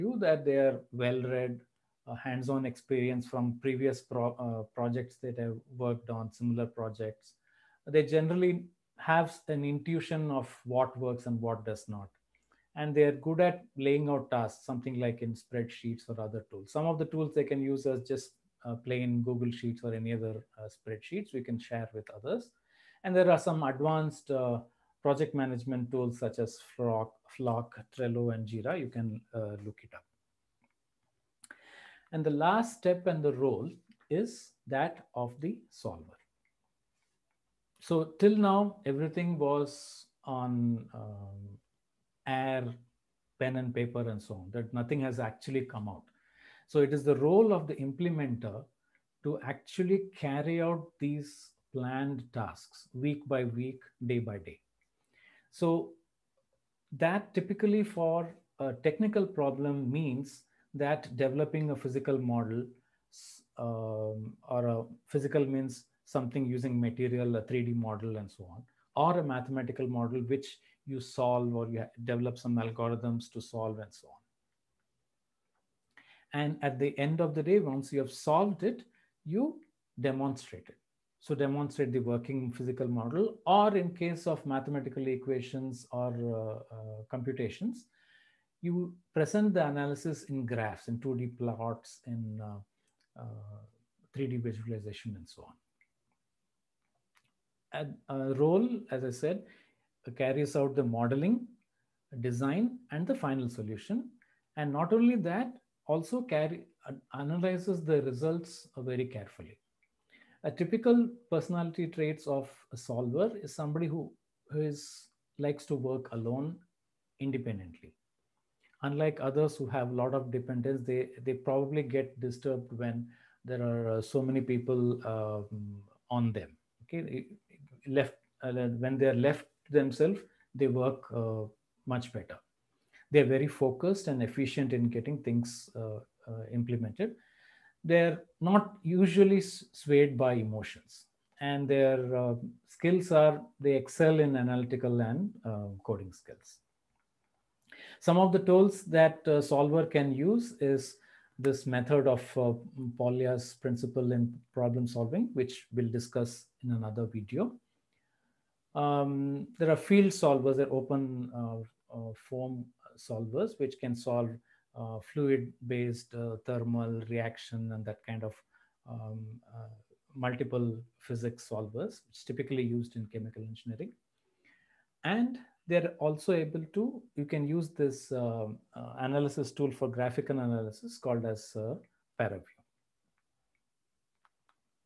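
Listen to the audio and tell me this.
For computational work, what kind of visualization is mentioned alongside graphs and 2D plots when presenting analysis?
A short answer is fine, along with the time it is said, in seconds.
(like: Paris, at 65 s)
3D visualization, at 94 s.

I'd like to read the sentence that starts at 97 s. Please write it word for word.
A role, as I said, carries out the modeling, design, and the final solution.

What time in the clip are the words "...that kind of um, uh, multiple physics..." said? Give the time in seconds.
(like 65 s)
167 s.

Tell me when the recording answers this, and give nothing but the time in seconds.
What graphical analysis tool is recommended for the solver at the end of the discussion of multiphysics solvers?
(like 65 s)
182 s.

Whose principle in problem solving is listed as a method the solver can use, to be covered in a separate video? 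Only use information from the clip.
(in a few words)
Polya's.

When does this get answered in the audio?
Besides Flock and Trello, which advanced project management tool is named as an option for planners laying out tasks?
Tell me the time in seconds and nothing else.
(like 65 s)
28 s.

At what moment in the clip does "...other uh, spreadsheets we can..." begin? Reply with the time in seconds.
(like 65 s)
20 s.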